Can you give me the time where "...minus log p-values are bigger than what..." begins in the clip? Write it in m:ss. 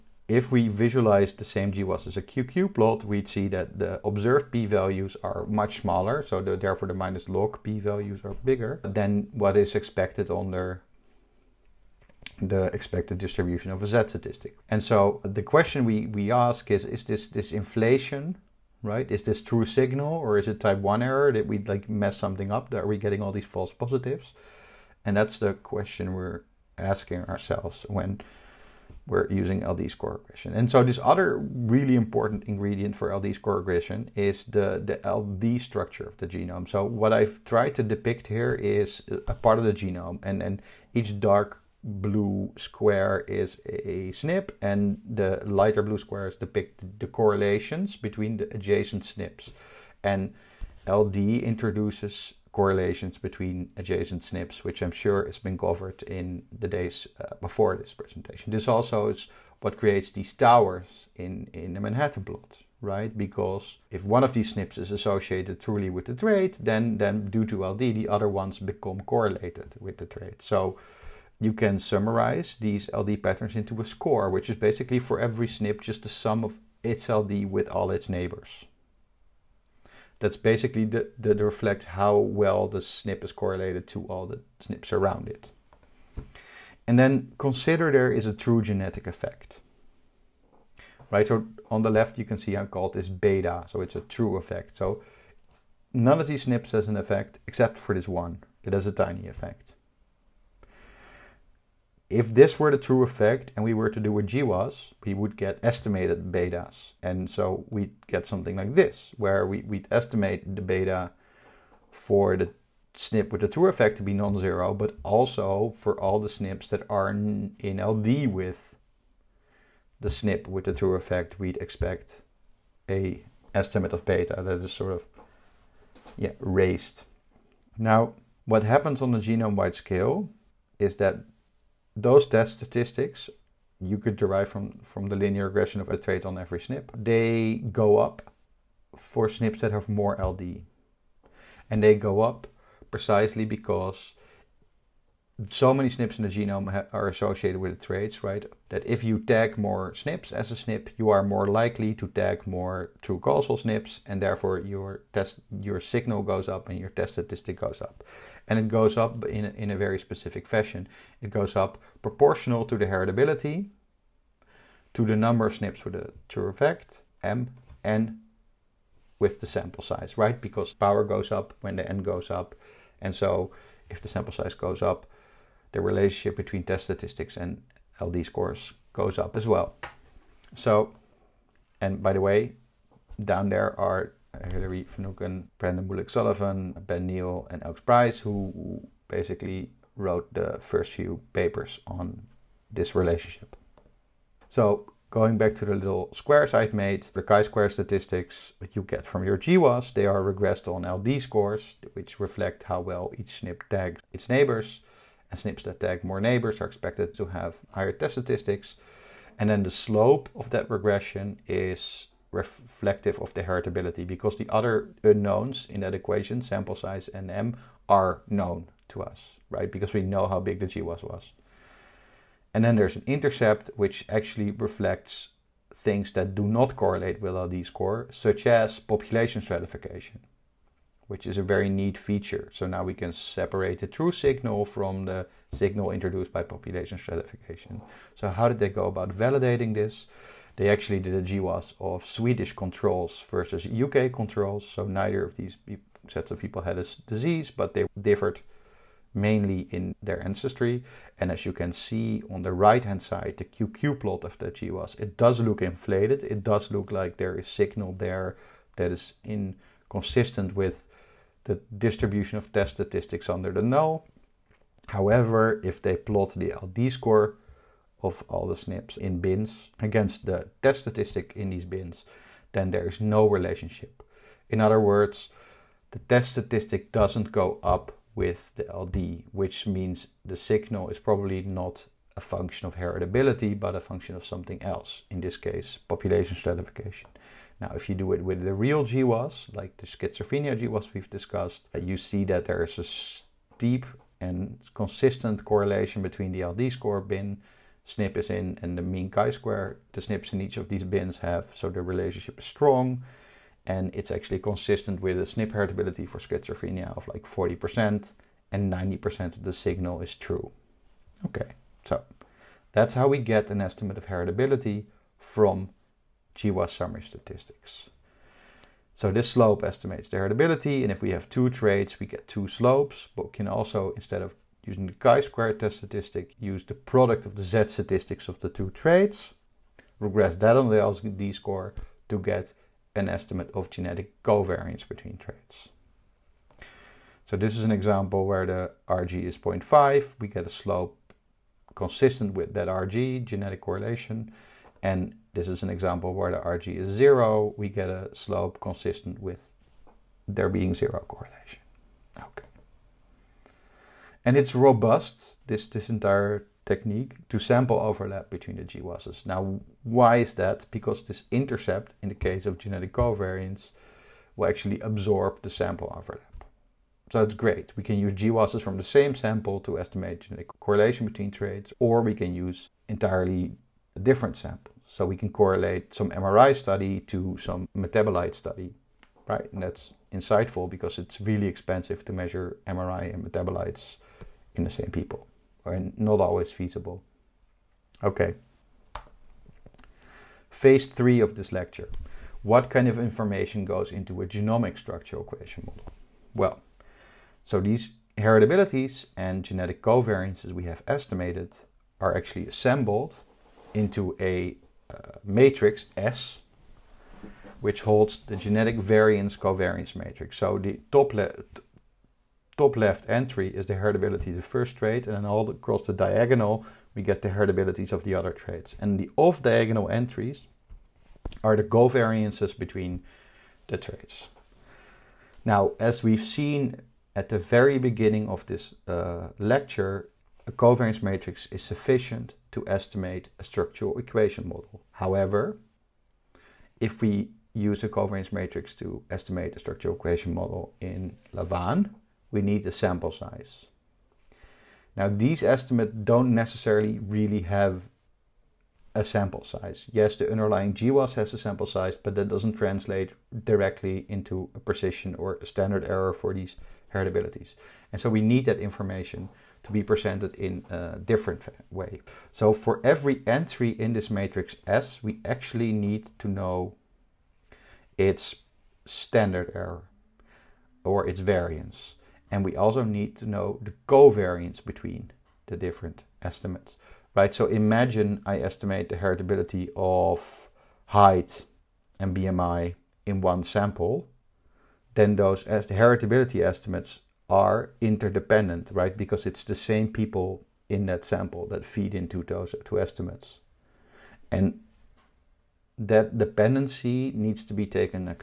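0:06.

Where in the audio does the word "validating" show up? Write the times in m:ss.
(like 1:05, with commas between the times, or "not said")
3:59.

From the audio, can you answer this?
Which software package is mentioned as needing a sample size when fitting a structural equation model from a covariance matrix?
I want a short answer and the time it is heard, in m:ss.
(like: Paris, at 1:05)
lavaan, at 7:21.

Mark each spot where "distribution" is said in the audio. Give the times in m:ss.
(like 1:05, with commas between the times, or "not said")
0:13, 4:21.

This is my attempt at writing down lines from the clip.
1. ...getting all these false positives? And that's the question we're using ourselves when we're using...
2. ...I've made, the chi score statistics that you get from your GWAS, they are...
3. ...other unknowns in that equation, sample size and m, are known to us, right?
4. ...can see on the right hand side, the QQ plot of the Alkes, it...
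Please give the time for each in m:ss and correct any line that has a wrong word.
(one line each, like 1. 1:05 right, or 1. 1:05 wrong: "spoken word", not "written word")
1. 0:22 wrong: "asking", not "using"
2. 3:16 wrong: "square", not "score"
3. 3:34 right
4. 4:11 wrong: "GWAS", not "Alkes".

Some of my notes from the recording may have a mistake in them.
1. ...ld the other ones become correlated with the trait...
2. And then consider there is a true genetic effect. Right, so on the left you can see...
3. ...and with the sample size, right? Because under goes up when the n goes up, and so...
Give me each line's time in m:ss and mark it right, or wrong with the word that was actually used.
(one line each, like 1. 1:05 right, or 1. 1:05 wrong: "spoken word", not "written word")
1. 1:07 right
2. 1:26 right
3. 2:47 wrong: "power", not "under".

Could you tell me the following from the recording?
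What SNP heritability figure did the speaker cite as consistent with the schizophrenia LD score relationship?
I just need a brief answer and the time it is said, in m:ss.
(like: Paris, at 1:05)
40%, at 5:07.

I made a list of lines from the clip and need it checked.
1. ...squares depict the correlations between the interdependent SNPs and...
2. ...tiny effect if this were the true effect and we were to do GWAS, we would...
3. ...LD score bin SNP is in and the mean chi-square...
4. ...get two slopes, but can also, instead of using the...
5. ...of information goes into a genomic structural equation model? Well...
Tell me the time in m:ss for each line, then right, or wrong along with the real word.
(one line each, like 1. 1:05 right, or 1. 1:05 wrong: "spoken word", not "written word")
1. 0:45 wrong: "adjacent", not "interdependent"
2. 1:38 right
3. 4:56 right
4. 5:22 right
5. 6:32 right.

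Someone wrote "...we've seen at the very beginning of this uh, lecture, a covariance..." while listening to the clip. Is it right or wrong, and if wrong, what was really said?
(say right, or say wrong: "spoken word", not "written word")
right.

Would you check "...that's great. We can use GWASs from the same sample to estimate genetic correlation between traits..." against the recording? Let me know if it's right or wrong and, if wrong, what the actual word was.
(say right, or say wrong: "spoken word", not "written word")
right.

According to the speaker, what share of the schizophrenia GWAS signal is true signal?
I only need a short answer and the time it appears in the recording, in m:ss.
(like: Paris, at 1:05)
90%, at 5:08.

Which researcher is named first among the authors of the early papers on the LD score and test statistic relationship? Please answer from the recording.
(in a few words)
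Hilary Finucane.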